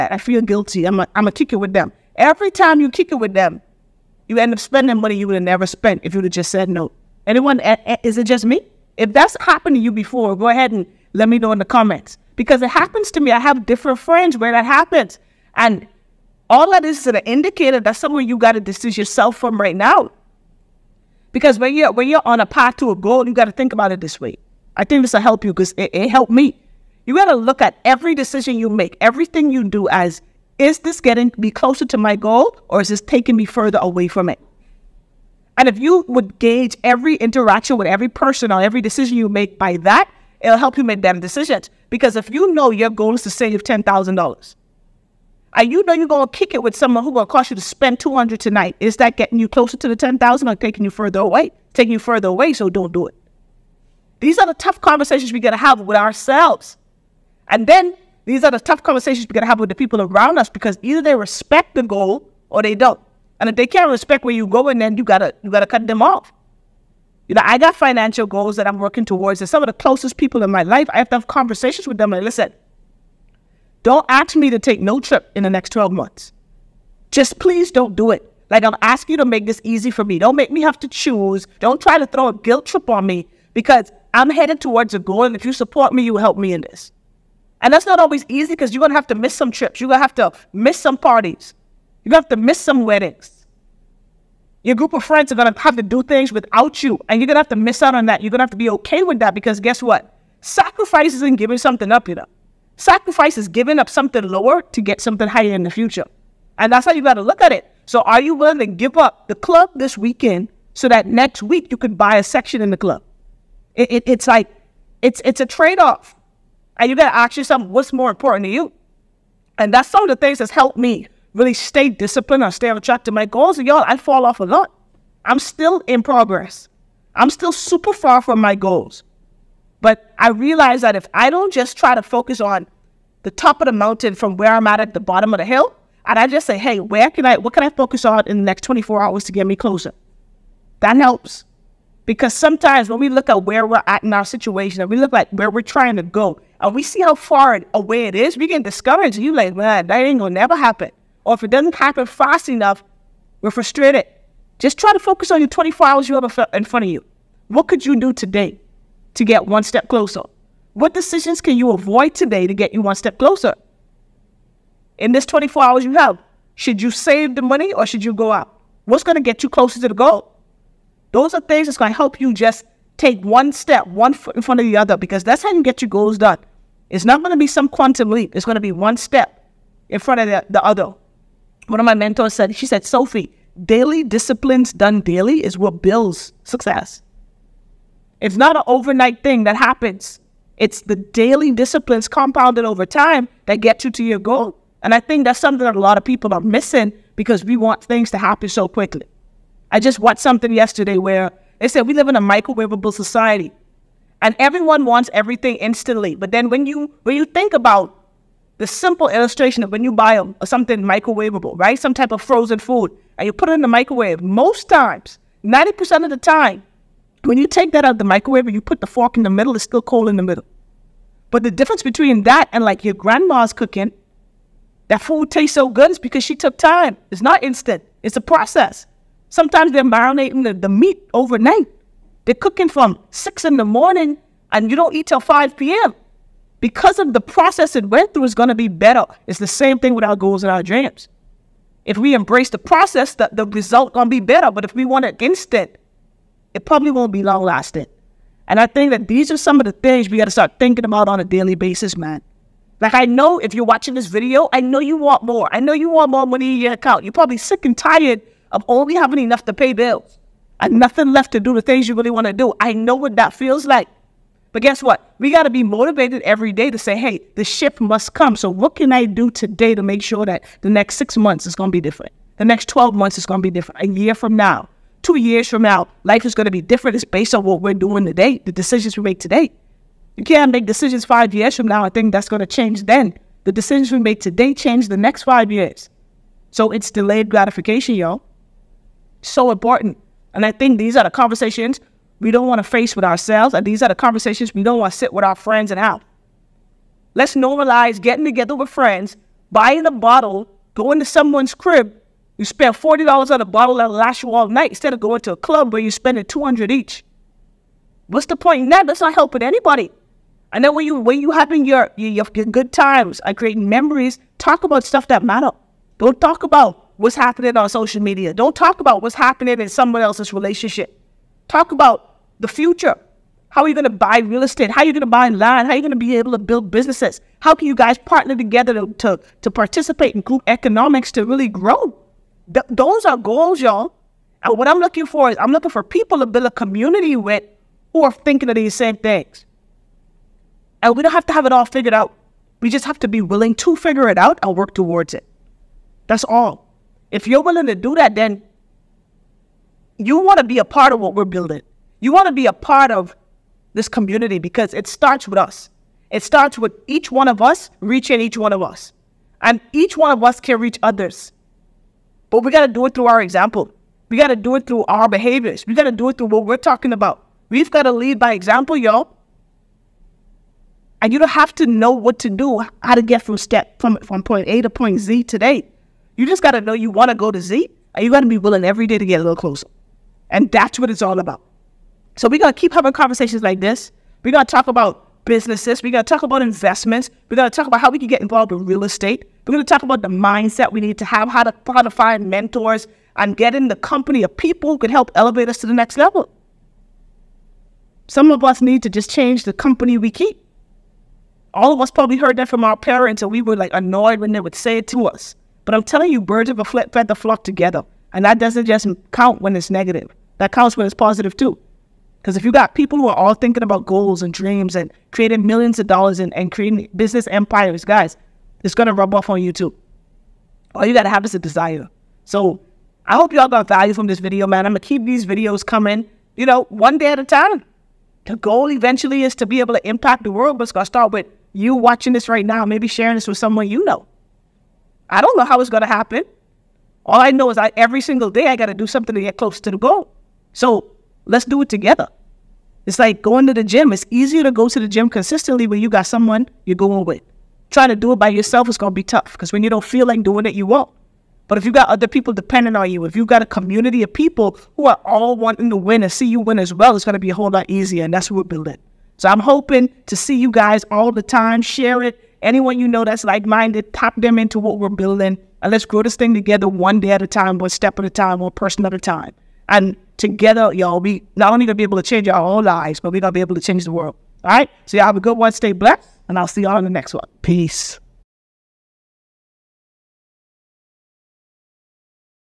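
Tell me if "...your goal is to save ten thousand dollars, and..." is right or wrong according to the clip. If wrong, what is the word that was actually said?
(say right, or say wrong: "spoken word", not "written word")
right.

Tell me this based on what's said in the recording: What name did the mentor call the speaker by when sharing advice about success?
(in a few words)
Sophie.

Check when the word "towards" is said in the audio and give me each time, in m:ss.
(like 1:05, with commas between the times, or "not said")
1:09, 1:24, 5:44.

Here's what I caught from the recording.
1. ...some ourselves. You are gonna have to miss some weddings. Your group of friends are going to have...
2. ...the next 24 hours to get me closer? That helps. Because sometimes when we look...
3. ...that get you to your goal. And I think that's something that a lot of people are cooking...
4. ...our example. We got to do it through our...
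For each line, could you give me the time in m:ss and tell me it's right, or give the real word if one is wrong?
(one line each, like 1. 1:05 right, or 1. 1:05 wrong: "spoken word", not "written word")
1. 1:30 wrong: "parties", not "ourselves"
2. 2:18 right
3. 3:13 wrong: "missing", not "cooking"
4. 6:03 right.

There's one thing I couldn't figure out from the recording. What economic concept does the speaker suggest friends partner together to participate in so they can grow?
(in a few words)
group economics.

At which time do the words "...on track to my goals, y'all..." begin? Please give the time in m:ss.
2:02.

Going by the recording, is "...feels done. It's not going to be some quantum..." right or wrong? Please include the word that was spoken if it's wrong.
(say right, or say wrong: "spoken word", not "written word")
wrong: "goals", not "feels".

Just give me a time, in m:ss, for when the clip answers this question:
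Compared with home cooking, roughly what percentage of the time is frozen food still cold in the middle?
3:35.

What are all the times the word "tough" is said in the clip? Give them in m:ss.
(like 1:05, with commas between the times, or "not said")
0:54, 0:58, 7:29.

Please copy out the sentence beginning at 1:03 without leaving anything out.
And if they can't respect where you go, and then you gotta you gotta cut them off.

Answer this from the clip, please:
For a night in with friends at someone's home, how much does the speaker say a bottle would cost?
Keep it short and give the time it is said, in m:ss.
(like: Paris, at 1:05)
$40, at 5:02.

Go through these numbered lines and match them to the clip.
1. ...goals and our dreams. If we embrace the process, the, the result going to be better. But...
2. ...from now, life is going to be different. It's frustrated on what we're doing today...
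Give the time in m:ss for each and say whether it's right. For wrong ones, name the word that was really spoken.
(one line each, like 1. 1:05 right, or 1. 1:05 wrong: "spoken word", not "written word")
1. 4:00 right
2. 4:35 wrong: "based", not "frustrated".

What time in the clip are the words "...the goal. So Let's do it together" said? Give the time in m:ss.
7:19.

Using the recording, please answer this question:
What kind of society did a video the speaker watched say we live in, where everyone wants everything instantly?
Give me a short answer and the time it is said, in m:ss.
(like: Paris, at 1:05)
microwavable society, at 3:22.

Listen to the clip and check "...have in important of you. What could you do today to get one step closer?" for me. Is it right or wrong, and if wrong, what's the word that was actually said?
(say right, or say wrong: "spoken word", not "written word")
wrong: "front", not "important".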